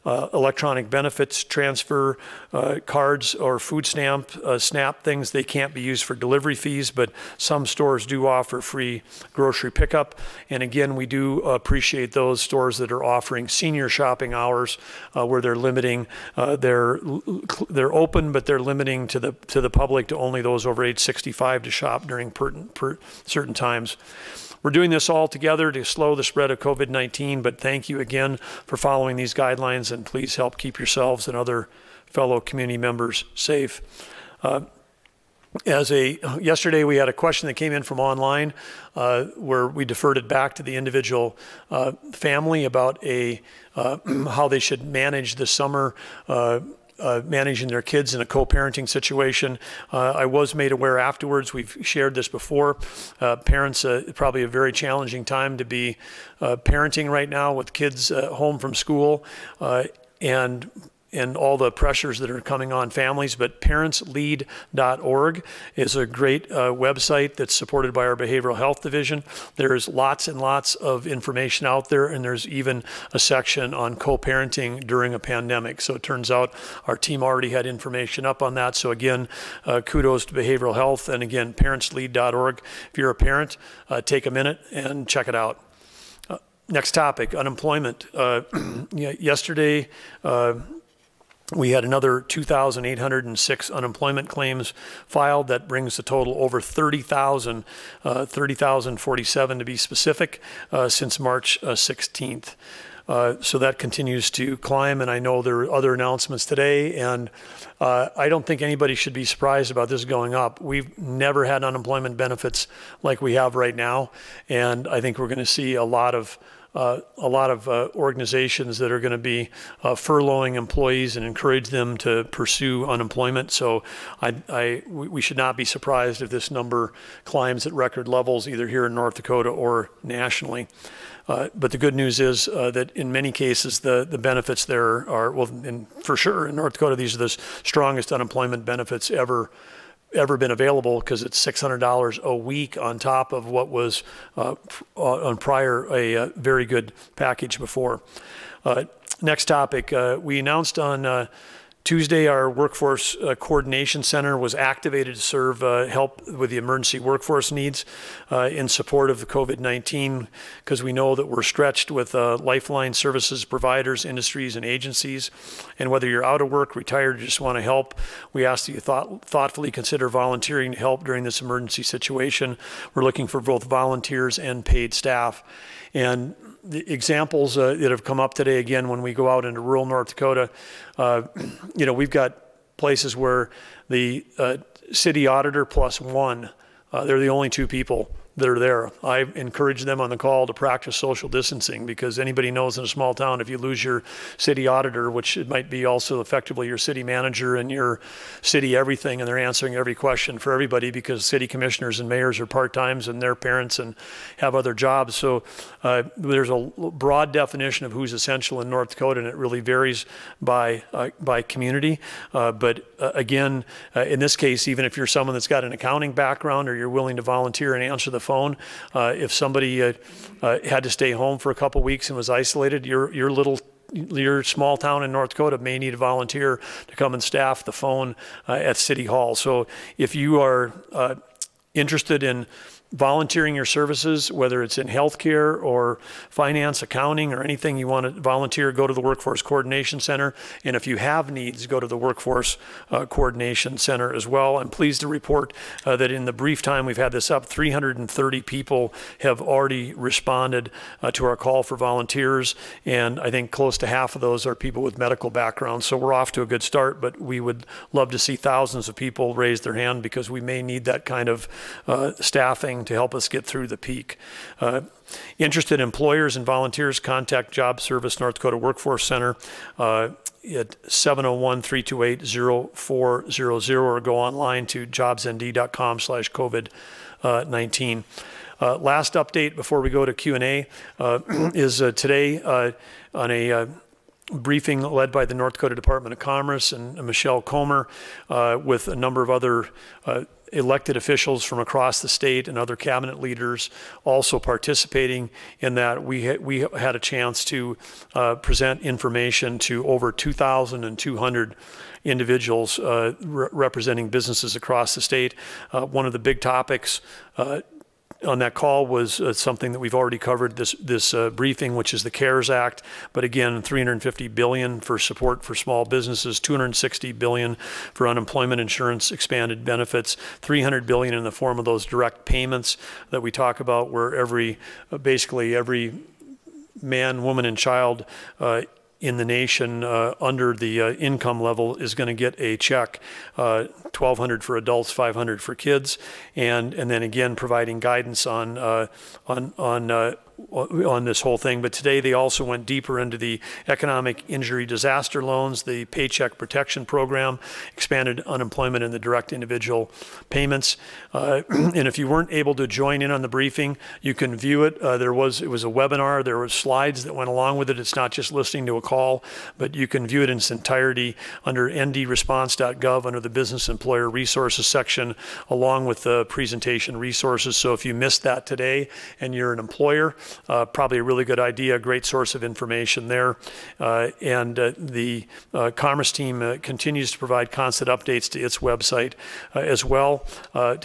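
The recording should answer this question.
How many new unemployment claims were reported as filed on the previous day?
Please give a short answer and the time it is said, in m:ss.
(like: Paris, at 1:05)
2,806, at 1:32.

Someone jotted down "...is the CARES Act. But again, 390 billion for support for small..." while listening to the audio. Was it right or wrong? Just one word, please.
wrong.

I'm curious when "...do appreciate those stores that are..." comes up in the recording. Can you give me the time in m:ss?
0:11.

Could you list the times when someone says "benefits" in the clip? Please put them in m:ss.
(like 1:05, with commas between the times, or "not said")
0:00, 1:52, 2:14, 2:18, 5:19.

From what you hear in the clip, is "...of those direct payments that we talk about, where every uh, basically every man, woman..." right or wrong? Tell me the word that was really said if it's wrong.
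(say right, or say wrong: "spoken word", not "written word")
right.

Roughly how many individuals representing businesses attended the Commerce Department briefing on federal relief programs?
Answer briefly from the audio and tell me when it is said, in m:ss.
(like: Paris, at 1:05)
over 2,200, at 4:59.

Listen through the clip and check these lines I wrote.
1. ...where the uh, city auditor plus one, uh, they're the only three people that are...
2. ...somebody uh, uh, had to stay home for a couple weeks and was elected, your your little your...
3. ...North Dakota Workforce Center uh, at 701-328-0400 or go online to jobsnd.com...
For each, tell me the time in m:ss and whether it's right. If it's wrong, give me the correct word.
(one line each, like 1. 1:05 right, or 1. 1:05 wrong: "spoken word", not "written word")
1. 3:03 wrong: "two", not "three"
2. 3:39 wrong: "isolated", not "elected"
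3. 4:28 right.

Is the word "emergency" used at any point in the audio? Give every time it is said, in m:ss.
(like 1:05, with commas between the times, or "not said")
2:36, 2:51.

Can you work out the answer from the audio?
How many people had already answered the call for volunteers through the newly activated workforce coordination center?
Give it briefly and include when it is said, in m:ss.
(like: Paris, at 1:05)
330, at 4:07.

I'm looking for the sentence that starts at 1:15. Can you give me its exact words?
So it turns out our team already had information up on that.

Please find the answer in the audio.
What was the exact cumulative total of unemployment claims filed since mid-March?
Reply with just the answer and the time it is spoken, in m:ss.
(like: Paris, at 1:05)
30,047, at 1:38.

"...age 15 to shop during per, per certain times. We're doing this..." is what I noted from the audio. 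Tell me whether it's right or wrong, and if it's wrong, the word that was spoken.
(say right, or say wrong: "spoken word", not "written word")
wrong: "65", not "15".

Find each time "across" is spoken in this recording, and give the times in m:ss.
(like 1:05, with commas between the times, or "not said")
4:51, 5:04.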